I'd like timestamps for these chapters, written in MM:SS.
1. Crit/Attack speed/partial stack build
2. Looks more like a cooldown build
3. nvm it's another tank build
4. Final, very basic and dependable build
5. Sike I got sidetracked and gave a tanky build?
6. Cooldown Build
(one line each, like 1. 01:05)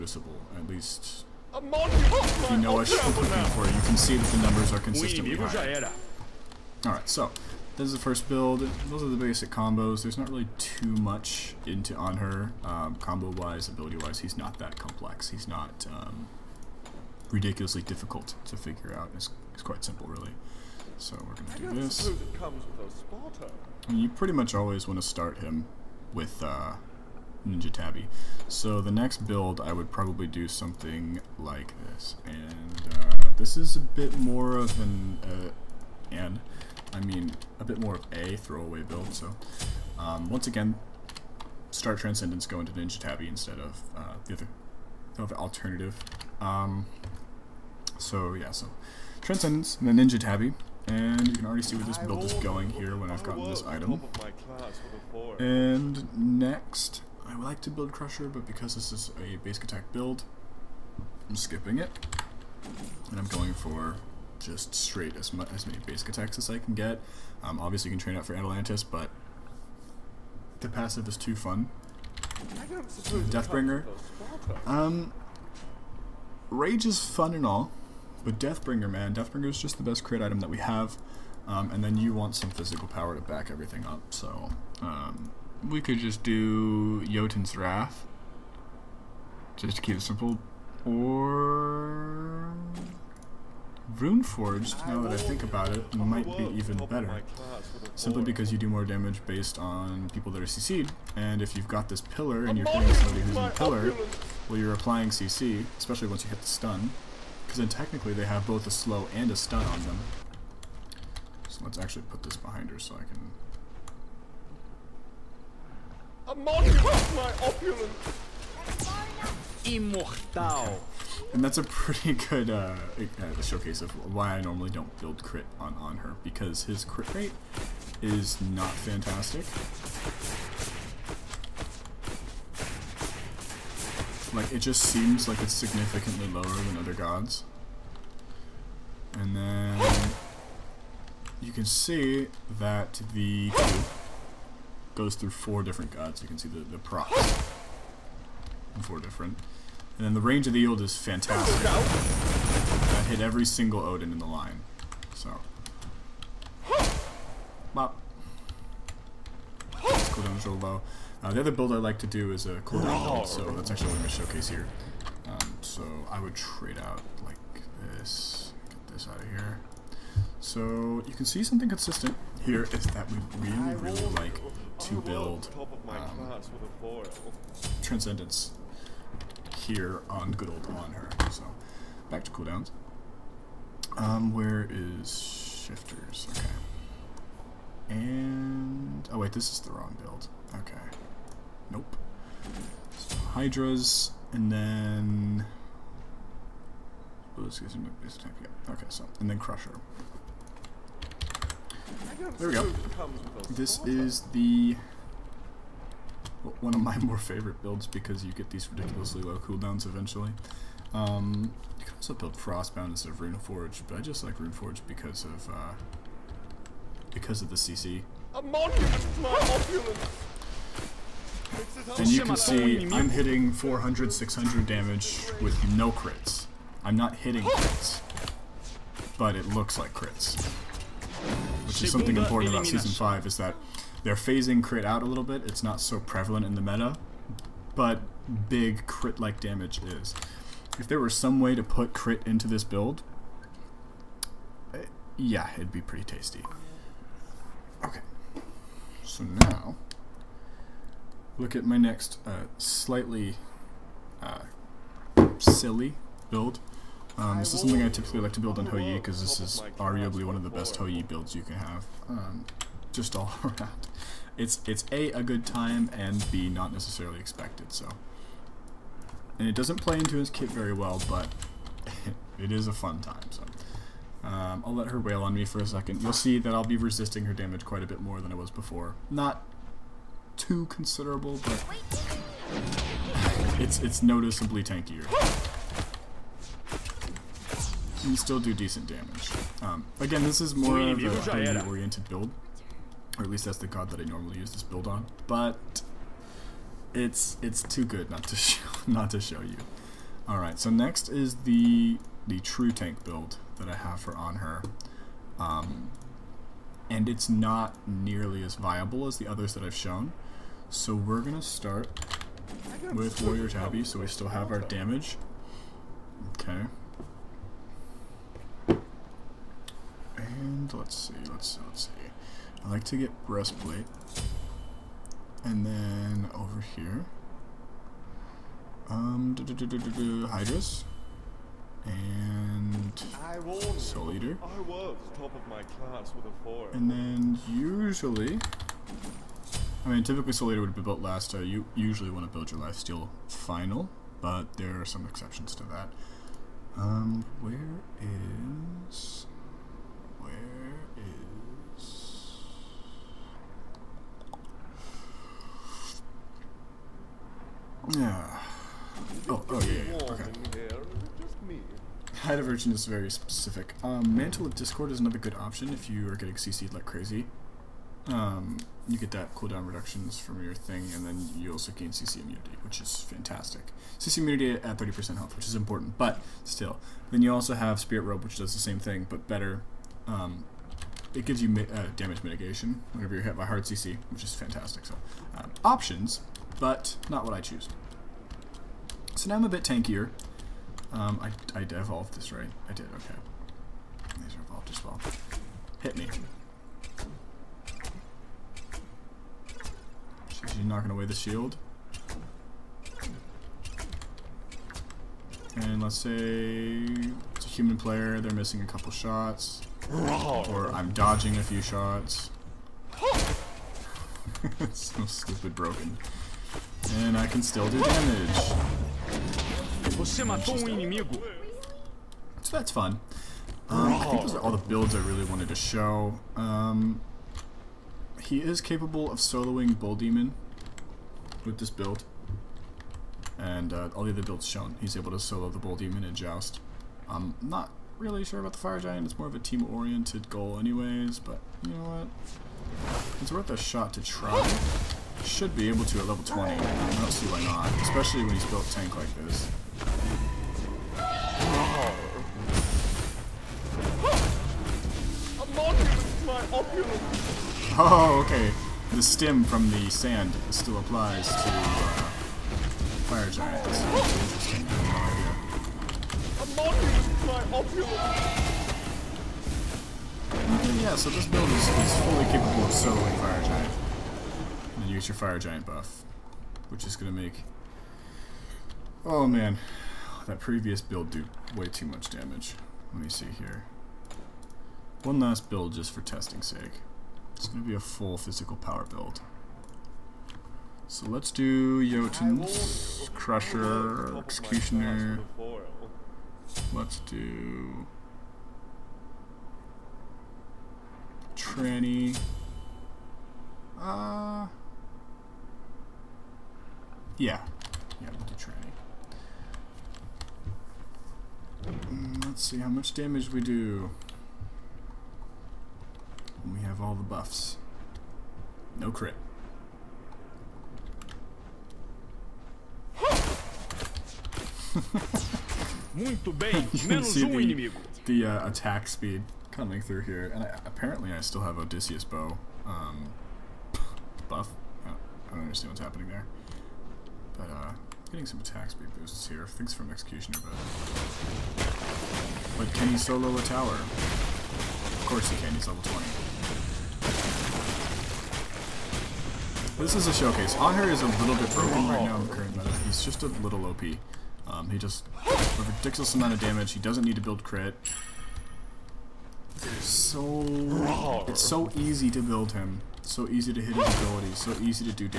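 1. 00:17
2. 05:24
3. 07:26
4. 08:11
5. 04:42
6. 02:50.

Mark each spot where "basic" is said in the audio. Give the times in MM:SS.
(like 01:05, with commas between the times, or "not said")
00:09, 00:59, 01:05.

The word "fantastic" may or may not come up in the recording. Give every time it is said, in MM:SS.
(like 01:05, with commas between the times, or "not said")
02:08, 02:30, 06:13, 06:24.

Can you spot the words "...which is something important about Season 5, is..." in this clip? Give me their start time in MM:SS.
03:51.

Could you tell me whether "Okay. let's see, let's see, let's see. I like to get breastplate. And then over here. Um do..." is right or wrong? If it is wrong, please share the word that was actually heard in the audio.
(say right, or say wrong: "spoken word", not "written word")
right.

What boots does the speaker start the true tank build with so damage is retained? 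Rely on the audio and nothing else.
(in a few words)
Warrior Tabi.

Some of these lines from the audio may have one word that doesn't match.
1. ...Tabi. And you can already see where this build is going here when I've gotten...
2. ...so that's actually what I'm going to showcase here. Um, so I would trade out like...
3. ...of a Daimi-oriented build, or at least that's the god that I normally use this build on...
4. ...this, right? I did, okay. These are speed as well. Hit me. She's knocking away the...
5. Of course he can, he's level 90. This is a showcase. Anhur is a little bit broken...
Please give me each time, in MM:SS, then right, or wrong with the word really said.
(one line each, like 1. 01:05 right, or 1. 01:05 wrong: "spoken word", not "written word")
1. 00:50 right
2. 02:43 right
3. 04:50 right
4. 06:32 wrong: "evolved", not "speed"
5. 09:03 wrong: "20", not "90".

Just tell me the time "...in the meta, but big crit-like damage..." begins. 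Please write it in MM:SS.
03:56.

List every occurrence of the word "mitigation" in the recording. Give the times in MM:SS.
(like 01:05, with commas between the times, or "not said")
06:22.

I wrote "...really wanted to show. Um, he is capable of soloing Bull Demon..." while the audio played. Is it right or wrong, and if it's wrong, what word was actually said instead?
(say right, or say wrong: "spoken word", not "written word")
right.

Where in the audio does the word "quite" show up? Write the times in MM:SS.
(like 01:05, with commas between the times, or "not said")
00:19, 04:37.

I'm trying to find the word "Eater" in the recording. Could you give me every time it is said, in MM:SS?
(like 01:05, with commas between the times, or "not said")
05:34, 05:40.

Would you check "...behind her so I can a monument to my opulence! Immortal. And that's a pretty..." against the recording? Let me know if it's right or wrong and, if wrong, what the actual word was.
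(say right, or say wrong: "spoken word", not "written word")
right.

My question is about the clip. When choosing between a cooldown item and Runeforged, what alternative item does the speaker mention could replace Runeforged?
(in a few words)
Frostbound.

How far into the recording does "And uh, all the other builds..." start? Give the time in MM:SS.
07:13.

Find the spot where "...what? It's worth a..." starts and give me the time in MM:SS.
07:21.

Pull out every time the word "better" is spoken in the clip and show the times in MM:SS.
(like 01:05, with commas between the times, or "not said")
01:36, 06:19.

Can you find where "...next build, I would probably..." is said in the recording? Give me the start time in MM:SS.
00:28.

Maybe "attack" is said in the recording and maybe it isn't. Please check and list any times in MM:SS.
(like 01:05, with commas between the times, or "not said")
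00:59, 01:06, 03:18, 08:48, 08:58.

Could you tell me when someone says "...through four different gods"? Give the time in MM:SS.
02:25.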